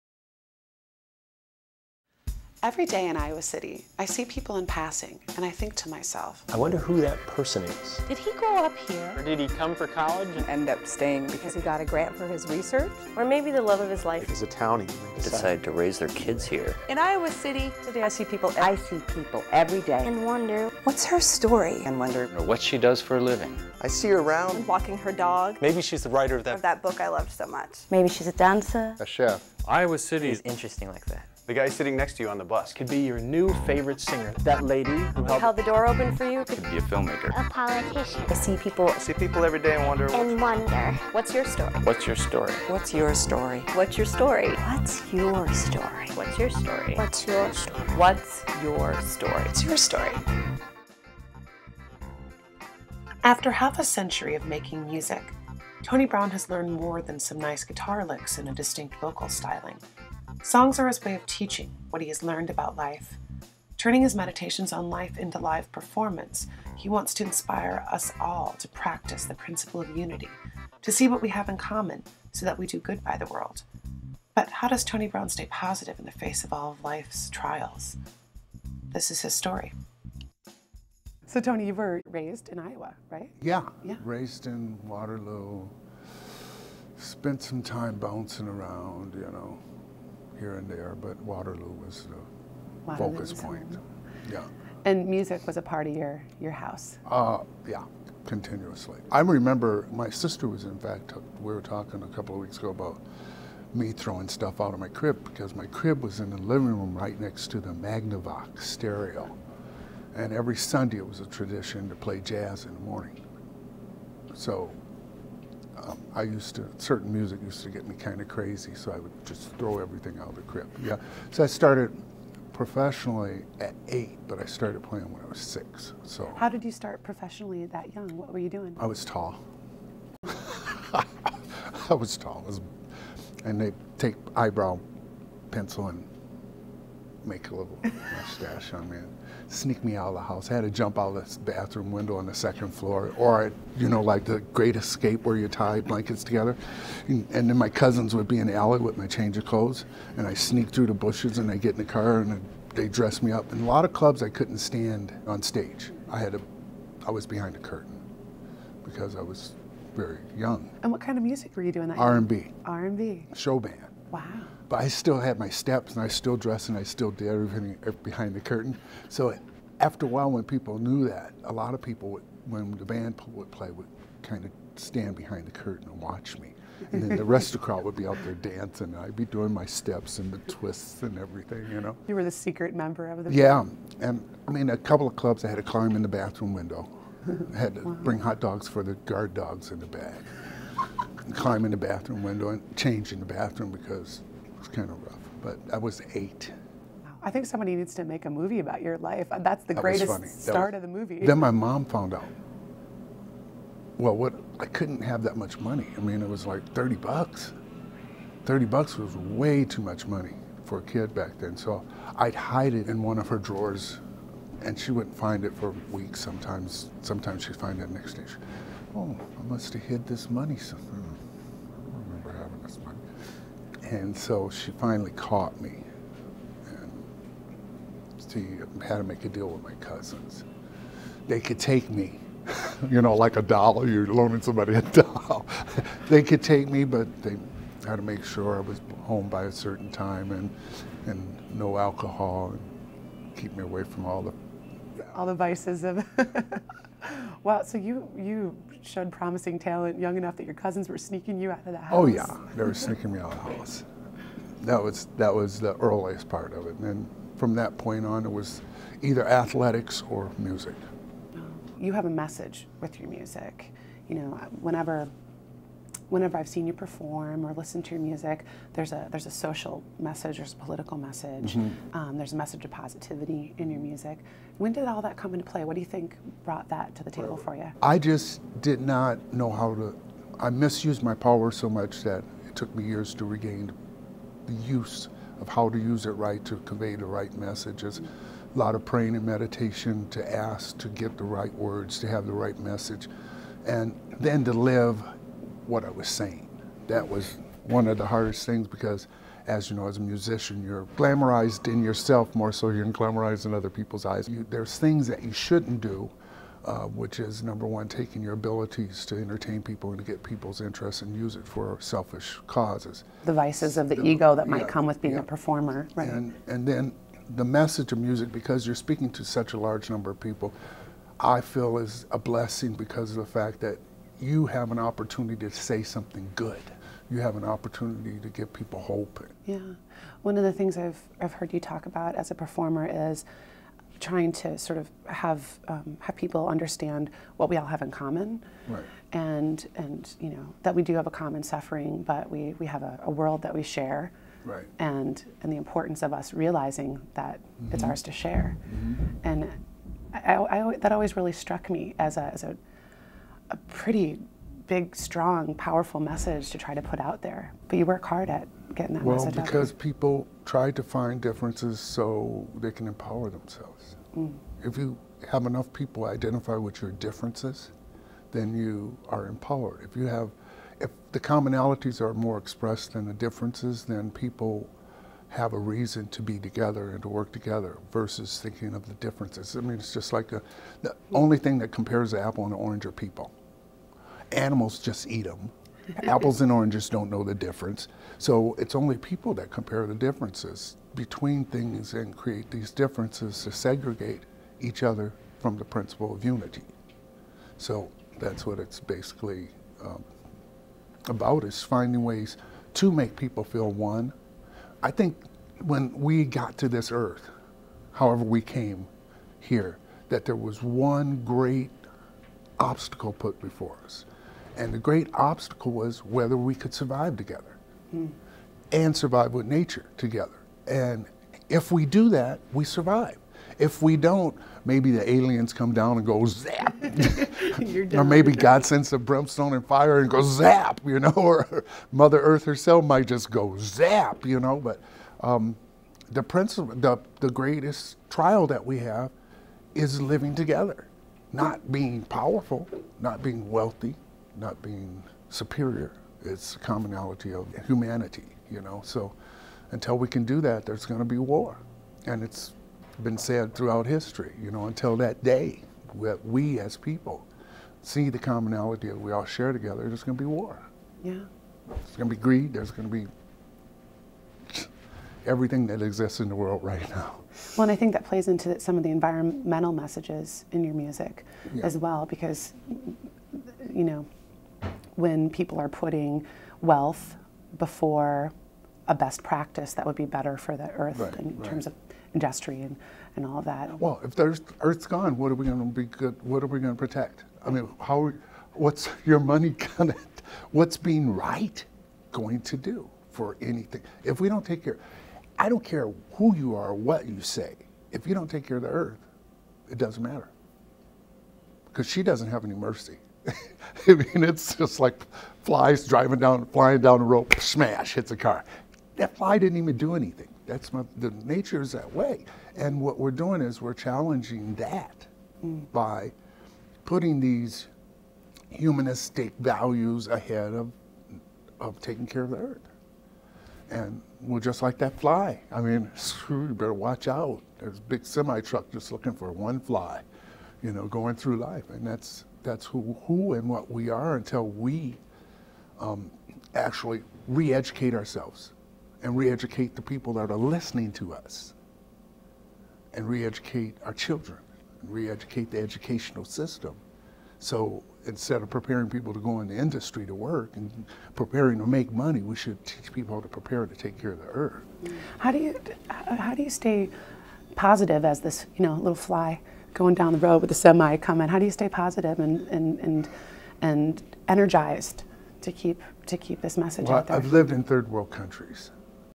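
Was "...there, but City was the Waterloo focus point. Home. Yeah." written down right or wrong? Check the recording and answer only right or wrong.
wrong.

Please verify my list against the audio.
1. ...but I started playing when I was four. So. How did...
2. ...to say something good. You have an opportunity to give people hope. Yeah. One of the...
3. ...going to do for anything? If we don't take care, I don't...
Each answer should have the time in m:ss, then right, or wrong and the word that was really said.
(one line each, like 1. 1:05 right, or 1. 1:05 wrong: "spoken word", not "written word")
1. 2:04 wrong: "six", not "four"
2. 5:25 right
3. 8:12 right.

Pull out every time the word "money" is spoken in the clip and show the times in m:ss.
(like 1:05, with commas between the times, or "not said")
3:25, 3:30, 3:40, 8:09, 9:11.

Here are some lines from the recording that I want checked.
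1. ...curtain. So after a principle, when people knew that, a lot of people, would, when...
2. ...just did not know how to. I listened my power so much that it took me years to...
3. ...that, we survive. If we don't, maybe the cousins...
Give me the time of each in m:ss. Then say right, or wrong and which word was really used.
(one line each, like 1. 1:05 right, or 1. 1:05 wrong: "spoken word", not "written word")
1. 2:48 wrong: "while", not "principle"
2. 4:37 wrong: "misused", not "listened"
3. 7:02 wrong: "aliens", not "cousins".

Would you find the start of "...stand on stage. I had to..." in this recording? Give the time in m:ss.
2:34.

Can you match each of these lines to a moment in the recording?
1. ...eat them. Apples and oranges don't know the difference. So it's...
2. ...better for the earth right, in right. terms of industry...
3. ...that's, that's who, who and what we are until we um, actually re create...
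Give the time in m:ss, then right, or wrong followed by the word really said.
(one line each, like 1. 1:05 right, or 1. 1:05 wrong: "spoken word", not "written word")
1. 6:25 right
2. 8:00 right
3. 8:51 wrong: "educate", not "create".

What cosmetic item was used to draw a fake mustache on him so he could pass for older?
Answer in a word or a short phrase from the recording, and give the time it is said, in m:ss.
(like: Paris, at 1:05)
Eyebrow pencil, at 2:14.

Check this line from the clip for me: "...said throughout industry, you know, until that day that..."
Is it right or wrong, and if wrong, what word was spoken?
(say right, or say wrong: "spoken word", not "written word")
wrong: "history", not "industry".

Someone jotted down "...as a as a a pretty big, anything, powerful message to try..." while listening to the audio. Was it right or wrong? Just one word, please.
wrong.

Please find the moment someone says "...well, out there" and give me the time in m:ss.
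9:26.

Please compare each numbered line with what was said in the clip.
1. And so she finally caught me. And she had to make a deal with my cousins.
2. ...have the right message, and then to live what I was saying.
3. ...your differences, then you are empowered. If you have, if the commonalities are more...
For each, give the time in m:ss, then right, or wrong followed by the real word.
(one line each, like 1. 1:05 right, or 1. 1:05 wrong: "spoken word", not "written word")
1. 3:43 right
2. 4:52 right
3. 6:06 right.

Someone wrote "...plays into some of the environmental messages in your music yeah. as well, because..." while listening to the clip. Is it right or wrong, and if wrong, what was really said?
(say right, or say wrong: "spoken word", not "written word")
right.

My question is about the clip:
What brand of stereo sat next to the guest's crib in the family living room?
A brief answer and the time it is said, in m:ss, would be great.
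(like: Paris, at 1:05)
Magnavox, at 1:47.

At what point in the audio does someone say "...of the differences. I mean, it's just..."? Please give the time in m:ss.
6:18.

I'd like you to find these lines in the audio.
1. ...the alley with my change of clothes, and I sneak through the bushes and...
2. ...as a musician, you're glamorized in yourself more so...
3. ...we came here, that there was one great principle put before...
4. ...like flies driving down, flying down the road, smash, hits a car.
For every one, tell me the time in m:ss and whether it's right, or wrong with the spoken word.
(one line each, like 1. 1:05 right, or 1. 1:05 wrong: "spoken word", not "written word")
1. 2:28 right
2. 4:59 right
3. 6:48 wrong: "obstacle", not "principle"
4. 8:24 right.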